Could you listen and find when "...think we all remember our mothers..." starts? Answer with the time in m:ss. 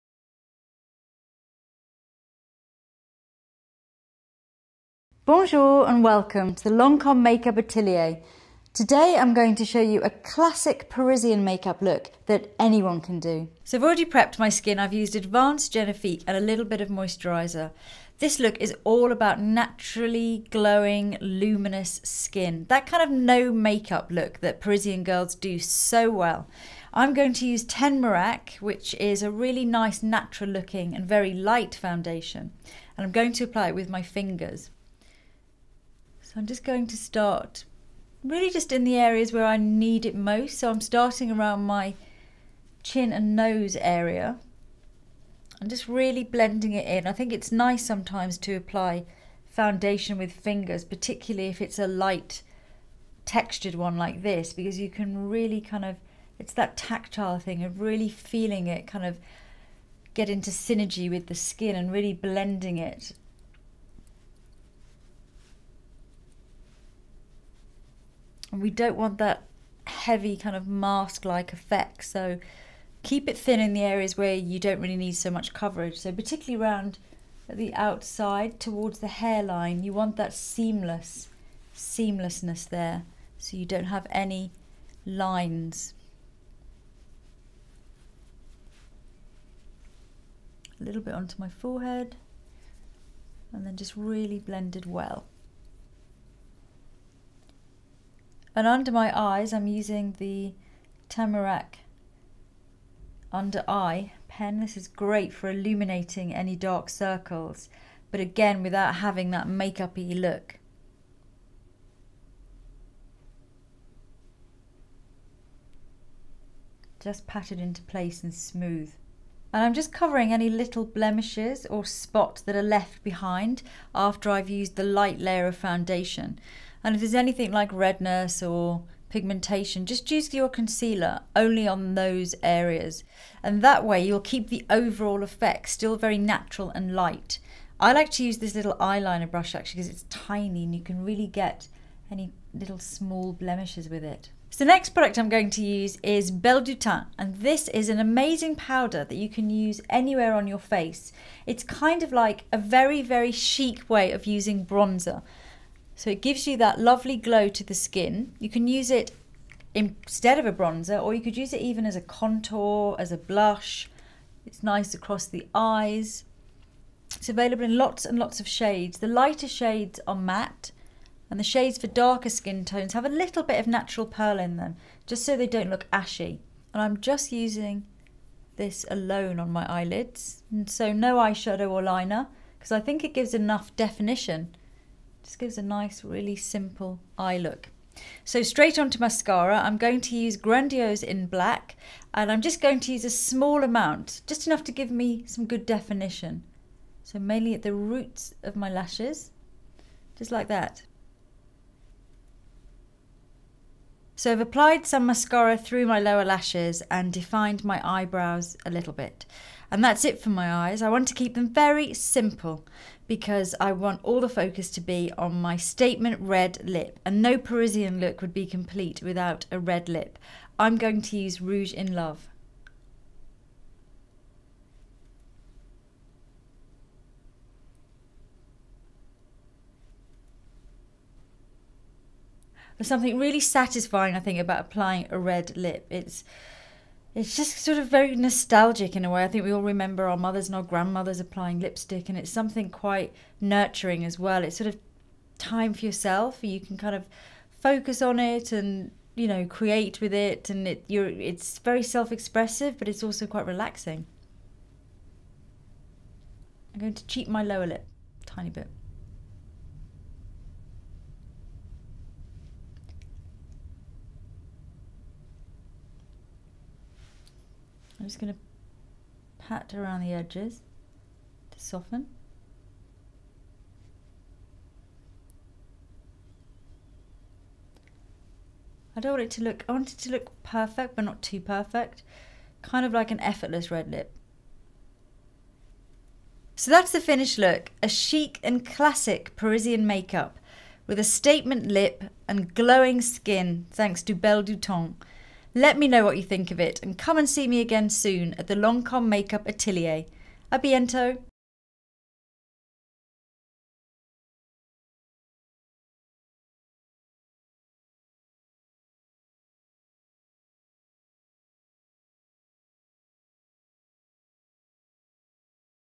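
3:59.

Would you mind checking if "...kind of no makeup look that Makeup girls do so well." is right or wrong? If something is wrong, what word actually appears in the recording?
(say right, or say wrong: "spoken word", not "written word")
wrong: "Parisian", not "Makeup".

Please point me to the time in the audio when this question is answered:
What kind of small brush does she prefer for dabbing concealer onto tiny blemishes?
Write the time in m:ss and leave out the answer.
2:18.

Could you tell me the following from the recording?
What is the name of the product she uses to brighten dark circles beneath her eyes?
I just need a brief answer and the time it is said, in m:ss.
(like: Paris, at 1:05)
Teint Miracle under eye pen, at 1:41.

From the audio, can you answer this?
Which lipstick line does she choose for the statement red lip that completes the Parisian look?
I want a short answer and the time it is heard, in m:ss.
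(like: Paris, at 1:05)
Rouge in Love, at 3:41.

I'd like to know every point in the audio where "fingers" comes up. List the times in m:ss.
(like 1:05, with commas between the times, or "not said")
0:34, 0:50.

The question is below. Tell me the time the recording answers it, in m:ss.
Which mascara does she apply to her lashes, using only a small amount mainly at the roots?
3:10.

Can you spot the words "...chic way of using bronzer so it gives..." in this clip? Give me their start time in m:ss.
2:33.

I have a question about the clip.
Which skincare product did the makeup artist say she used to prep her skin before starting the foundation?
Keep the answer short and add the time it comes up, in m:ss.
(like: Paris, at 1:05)
Advanced Genifique, at 0:15.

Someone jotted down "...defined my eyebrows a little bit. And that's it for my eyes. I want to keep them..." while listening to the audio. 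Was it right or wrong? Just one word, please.
right.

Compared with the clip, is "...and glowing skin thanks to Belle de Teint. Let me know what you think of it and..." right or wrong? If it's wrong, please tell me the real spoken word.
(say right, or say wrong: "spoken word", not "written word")
right.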